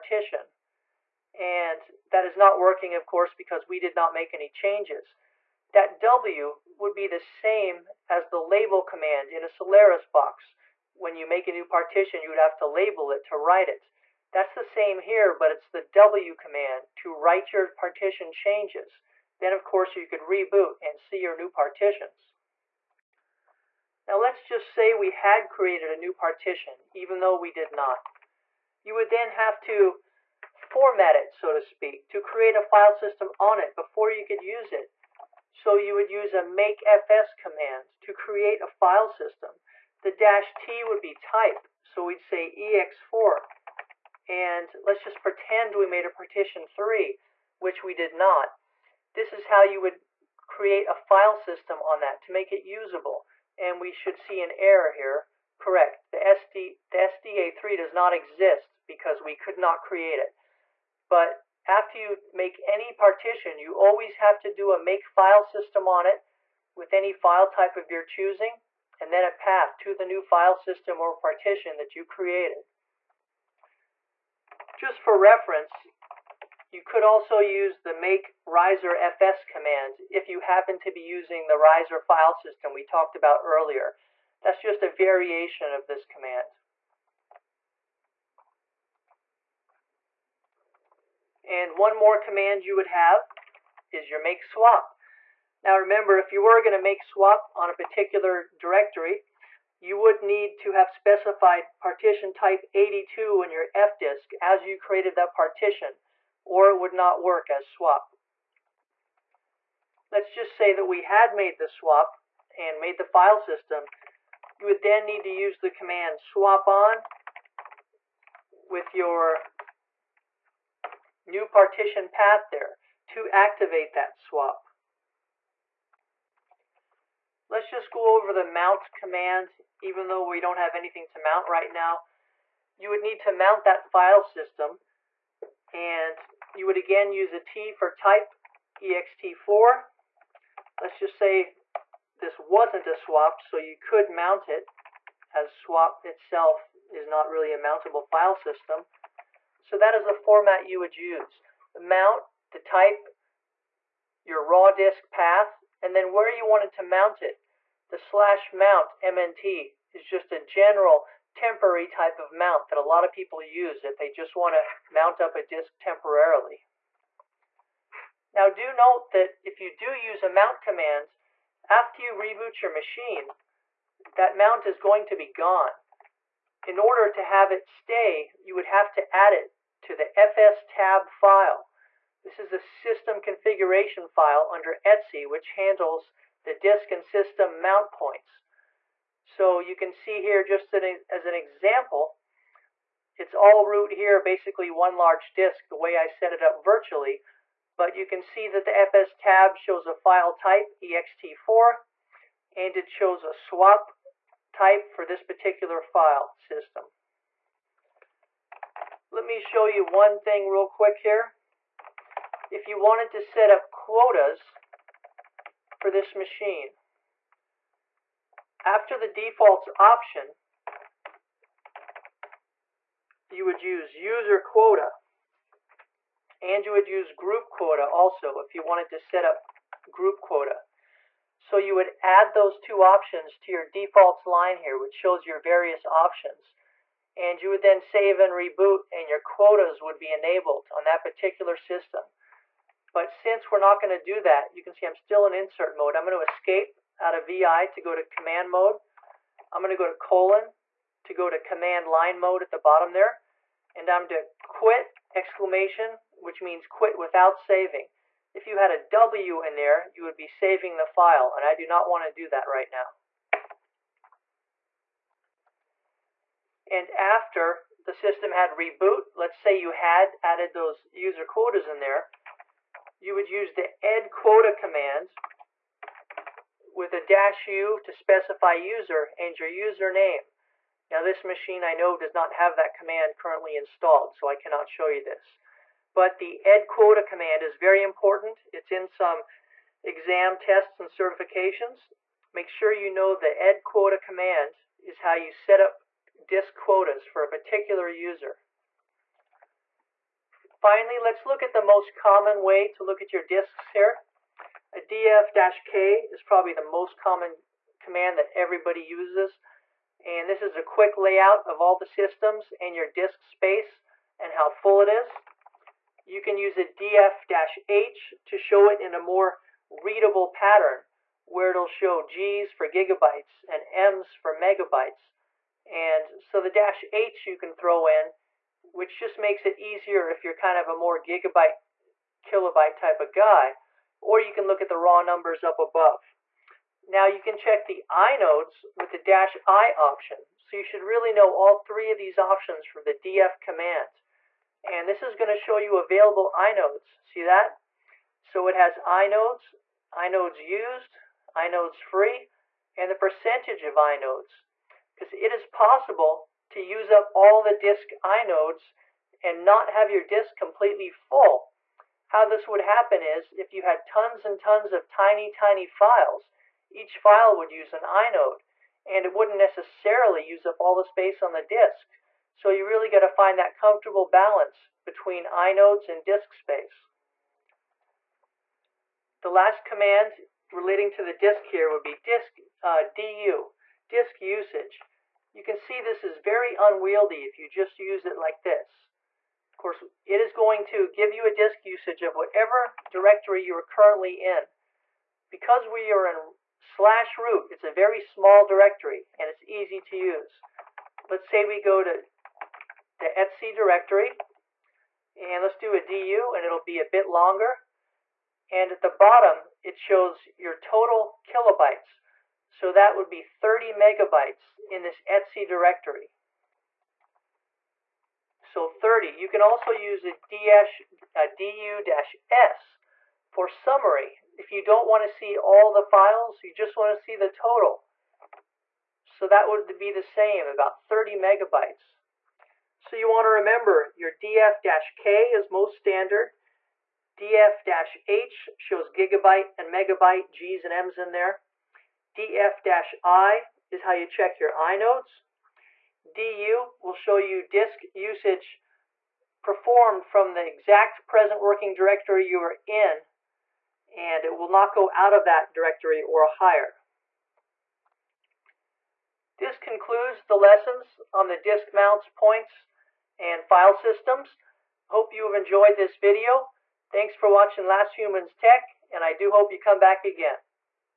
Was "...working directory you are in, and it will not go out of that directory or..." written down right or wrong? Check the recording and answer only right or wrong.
right.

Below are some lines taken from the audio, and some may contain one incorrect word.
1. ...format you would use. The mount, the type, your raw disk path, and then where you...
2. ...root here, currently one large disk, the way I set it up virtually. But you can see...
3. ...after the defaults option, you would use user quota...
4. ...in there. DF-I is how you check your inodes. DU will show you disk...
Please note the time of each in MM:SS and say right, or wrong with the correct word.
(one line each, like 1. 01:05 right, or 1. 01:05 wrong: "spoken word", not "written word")
1. 02:30 right
2. 03:13 wrong: "basically", not "currently"
3. 03:38 right
4. 07:20 right.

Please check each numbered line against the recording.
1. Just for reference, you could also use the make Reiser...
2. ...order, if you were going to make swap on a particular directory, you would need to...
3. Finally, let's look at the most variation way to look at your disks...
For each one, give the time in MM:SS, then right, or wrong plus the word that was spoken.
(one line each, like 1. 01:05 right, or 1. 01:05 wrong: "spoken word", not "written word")
1. 01:14 right
2. 01:35 wrong: "remember", not "order"
3. 05:00 wrong: "common", not "variation".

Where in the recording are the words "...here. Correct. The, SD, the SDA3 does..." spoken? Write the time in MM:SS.
00:54.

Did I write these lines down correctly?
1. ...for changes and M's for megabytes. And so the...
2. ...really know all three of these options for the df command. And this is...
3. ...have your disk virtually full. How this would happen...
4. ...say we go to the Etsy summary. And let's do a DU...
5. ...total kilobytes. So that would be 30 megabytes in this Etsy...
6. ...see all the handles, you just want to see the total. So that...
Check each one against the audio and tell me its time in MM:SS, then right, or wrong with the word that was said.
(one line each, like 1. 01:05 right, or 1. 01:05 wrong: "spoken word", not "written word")
1. 05:22 wrong: "gigabytes", not "changes"
2. 05:40 right
3. 05:59 wrong: "completely", not "virtually"
4. 06:41 wrong: "directory", not "summary"
5. 06:50 right
6. 07:05 wrong: "files", not "handles".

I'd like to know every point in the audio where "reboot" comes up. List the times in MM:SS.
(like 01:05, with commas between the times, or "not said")
00:20, 02:52, 03:58, 04:28.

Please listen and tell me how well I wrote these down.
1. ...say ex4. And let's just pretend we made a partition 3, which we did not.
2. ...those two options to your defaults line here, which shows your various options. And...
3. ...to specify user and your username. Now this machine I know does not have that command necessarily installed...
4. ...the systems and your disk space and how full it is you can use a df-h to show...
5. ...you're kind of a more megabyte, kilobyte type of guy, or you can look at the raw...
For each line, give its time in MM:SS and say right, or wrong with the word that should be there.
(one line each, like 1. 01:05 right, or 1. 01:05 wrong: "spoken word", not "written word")
1. 00:42 right
2. 03:52 right
3. 04:37 wrong: "currently", not "necessarily"
4. 05:11 right
5. 05:30 wrong: "gigabyte", not "megabyte".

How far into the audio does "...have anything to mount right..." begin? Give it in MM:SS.
02:10.